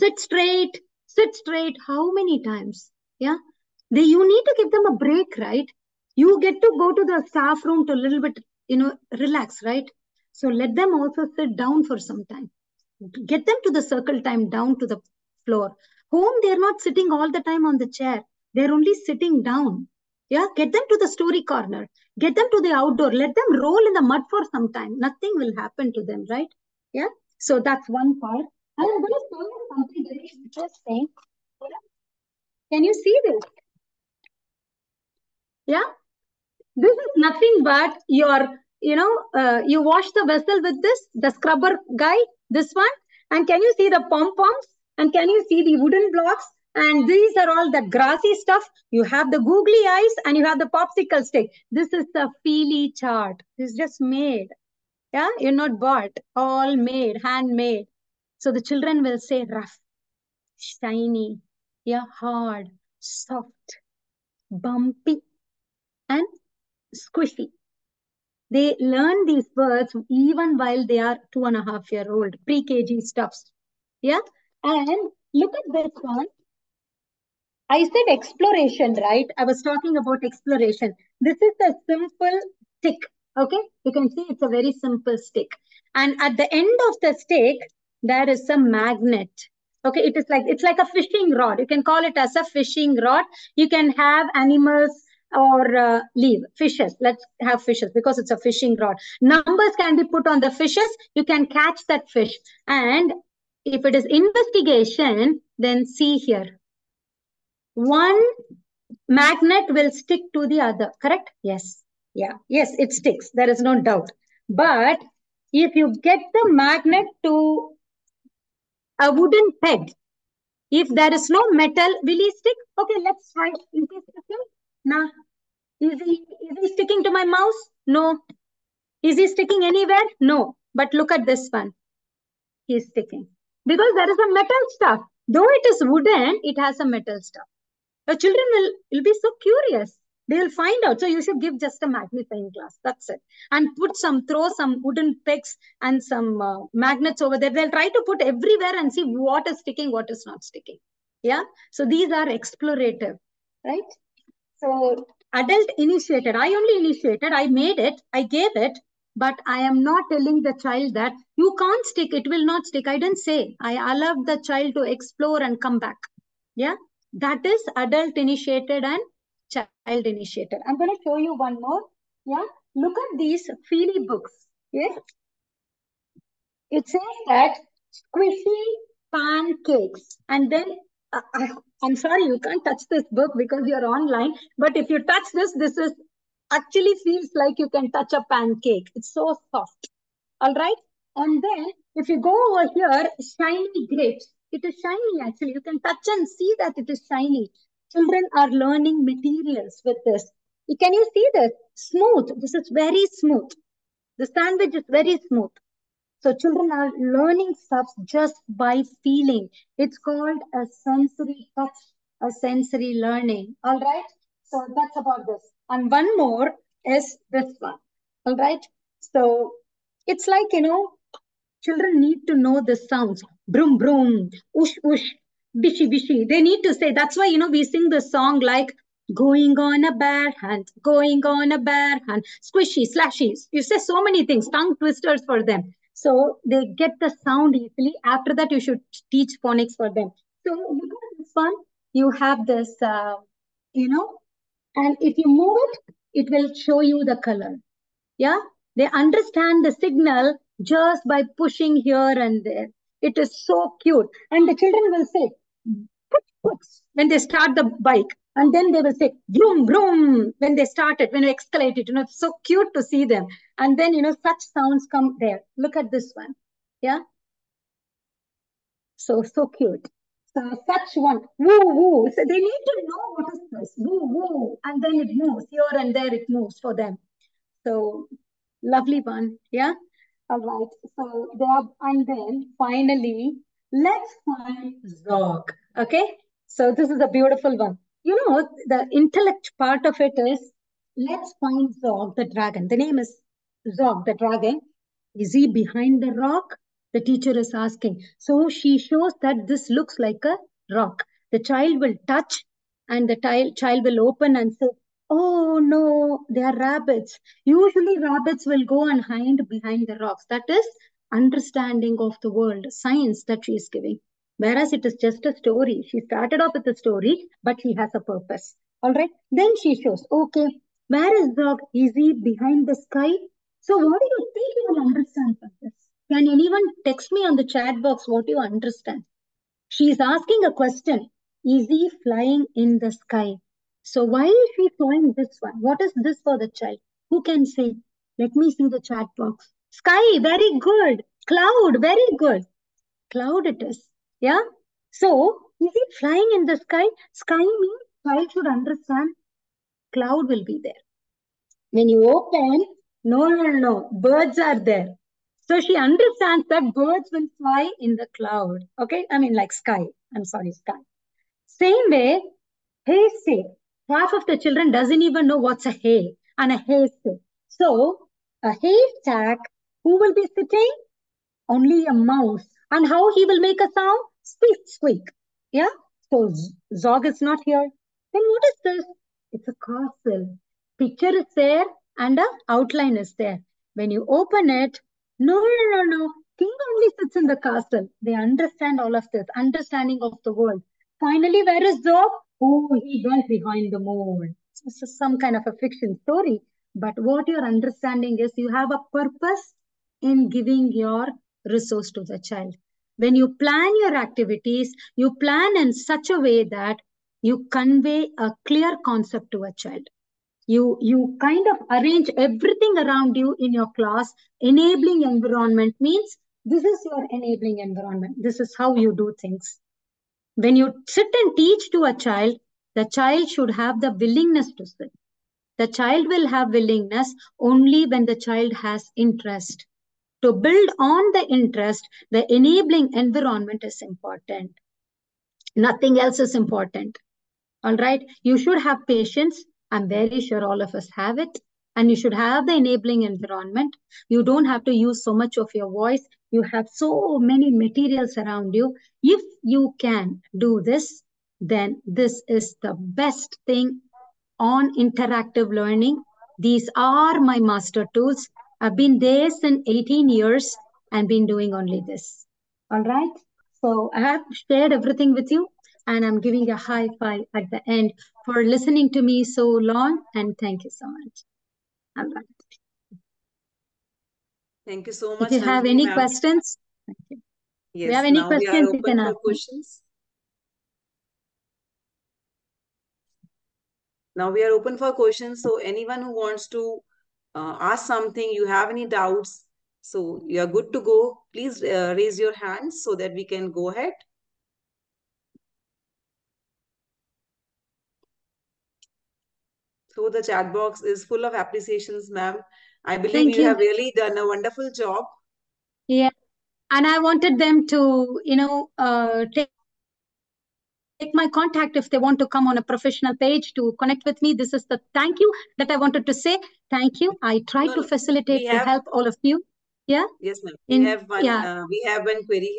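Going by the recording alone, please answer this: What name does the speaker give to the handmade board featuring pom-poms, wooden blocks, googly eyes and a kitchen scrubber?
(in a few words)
Feely chart.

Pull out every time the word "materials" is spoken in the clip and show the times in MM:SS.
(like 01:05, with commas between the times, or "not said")
03:19, 07:27.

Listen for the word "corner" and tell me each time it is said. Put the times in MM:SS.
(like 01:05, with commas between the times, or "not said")
00:21.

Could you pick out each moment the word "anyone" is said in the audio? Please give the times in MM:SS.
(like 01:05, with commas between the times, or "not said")
05:26, 08:05.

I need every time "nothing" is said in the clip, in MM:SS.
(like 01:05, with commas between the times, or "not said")
00:24, 00:37, 07:15.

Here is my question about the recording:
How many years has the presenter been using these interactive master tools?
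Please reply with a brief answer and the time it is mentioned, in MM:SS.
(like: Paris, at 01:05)
18, at 07:39.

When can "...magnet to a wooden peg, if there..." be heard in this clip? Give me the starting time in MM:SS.
01:56.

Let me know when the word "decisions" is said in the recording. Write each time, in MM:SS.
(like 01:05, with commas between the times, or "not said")
not said.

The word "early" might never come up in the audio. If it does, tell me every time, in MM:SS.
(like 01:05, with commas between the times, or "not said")
not said.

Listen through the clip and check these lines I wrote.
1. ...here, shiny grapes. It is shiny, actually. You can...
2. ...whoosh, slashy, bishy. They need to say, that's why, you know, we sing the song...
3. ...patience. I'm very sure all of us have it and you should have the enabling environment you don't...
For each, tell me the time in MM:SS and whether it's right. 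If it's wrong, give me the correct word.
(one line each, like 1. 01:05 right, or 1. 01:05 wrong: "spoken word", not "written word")
1. 03:12 right
2. 03:44 wrong: "bishy", not "slashy"
3. 07:18 right.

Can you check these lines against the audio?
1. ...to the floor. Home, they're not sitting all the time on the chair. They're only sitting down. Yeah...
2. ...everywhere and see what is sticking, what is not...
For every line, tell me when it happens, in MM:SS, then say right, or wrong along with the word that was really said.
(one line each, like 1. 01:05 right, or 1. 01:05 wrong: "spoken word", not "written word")
1. 00:14 right
2. 02:28 right.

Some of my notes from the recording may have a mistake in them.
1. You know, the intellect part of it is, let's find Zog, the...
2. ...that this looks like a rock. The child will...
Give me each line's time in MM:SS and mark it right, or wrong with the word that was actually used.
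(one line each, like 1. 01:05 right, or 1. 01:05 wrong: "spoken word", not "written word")
1. 04:48 right
2. 04:59 right.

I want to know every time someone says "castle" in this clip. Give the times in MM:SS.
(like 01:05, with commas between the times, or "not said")
06:19, 06:27.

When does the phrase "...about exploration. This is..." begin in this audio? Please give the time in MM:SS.
01:19.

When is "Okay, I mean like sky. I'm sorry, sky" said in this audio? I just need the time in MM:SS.
05:58.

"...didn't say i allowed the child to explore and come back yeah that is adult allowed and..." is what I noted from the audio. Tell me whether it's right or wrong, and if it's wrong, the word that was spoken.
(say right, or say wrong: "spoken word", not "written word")
wrong: "initiated", not "allowed".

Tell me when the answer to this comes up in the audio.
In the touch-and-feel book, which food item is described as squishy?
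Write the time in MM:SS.
02:57.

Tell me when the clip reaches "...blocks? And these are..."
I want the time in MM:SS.
00:46.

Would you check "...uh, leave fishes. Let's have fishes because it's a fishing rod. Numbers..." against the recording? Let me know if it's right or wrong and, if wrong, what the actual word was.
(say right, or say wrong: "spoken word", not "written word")
right.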